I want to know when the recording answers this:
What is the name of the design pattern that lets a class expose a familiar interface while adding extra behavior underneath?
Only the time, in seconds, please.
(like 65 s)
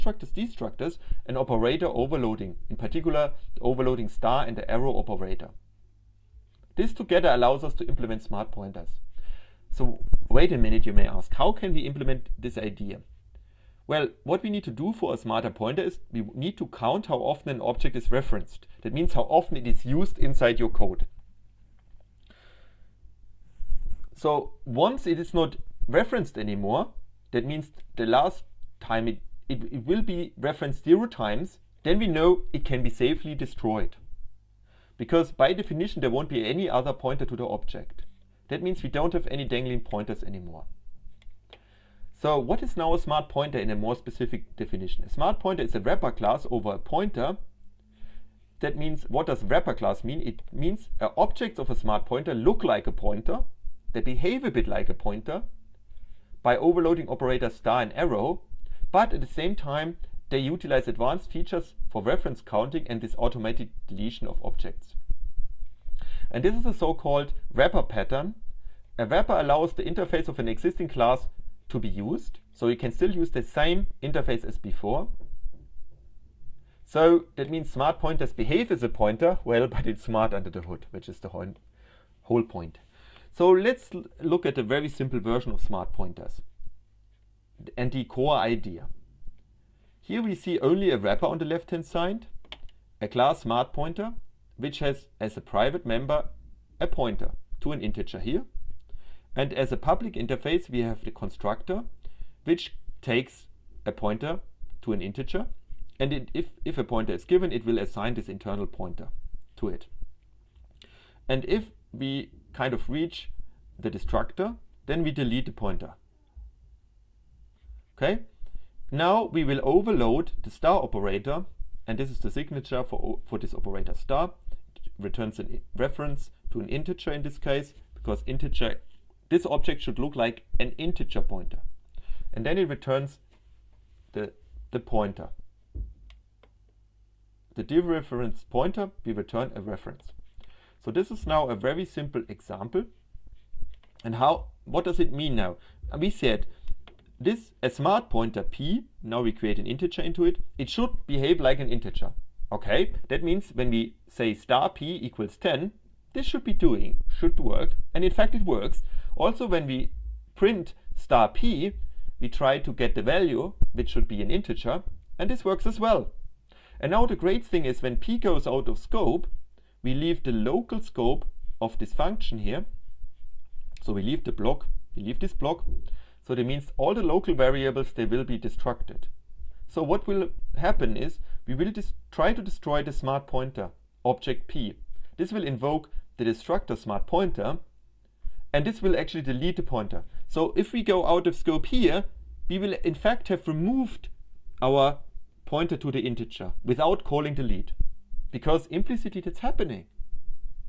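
67 s.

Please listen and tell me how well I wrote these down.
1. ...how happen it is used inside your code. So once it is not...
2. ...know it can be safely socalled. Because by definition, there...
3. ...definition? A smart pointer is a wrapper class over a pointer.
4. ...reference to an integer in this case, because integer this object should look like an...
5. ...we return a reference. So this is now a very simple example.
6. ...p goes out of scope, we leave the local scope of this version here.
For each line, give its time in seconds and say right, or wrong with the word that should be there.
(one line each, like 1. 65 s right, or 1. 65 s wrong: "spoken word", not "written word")
1. 19 s wrong: "often", not "happen"
2. 32 s wrong: "destroyed", not "socalled"
3. 44 s right
4. 125 s right
5. 139 s right
6. 167 s wrong: "function", not "version".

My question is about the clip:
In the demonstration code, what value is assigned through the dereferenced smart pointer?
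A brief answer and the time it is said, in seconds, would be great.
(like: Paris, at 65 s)
10, at 155 s.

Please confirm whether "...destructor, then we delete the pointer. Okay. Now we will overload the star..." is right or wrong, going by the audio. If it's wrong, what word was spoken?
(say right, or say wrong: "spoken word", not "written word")
right.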